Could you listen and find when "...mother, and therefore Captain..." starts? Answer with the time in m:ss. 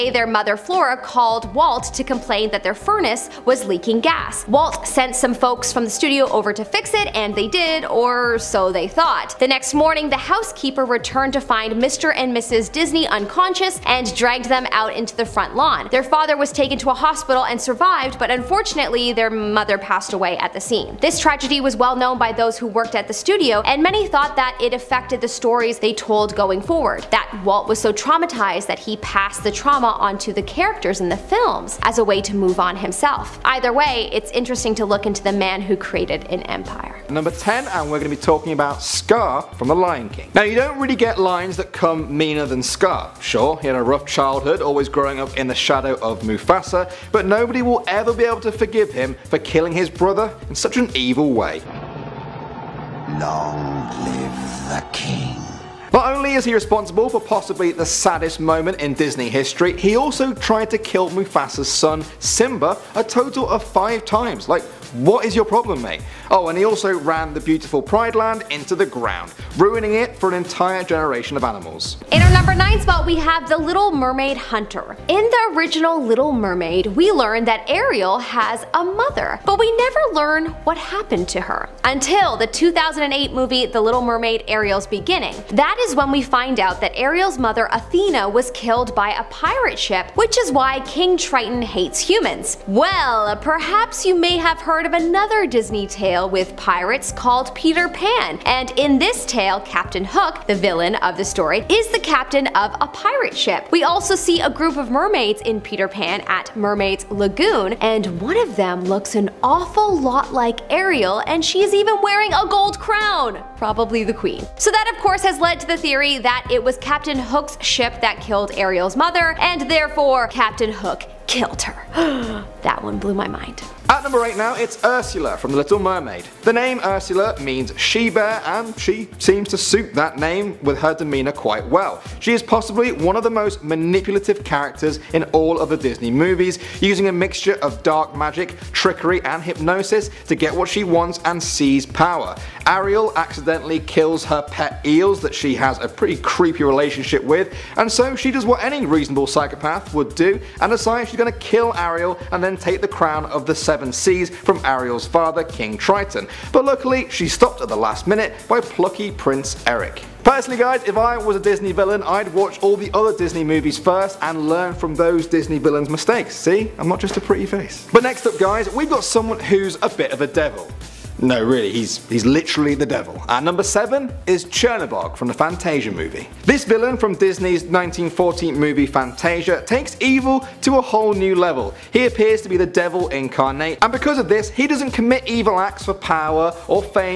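1:58.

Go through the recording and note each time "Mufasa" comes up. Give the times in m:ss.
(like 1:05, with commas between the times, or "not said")
0:46, 1:01.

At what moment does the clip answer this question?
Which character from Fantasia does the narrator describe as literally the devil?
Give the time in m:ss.
2:54.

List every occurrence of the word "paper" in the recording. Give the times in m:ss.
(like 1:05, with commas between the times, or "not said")
not said.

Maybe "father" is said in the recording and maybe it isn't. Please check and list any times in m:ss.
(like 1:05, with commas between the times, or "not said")
0:16, 2:35.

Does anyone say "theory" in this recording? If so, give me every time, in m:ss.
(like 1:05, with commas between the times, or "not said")
1:55.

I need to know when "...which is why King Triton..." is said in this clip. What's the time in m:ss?
1:30.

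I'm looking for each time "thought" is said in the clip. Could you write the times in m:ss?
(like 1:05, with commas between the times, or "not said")
0:08, 0:24.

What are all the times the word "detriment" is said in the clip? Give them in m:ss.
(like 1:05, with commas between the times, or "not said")
not said.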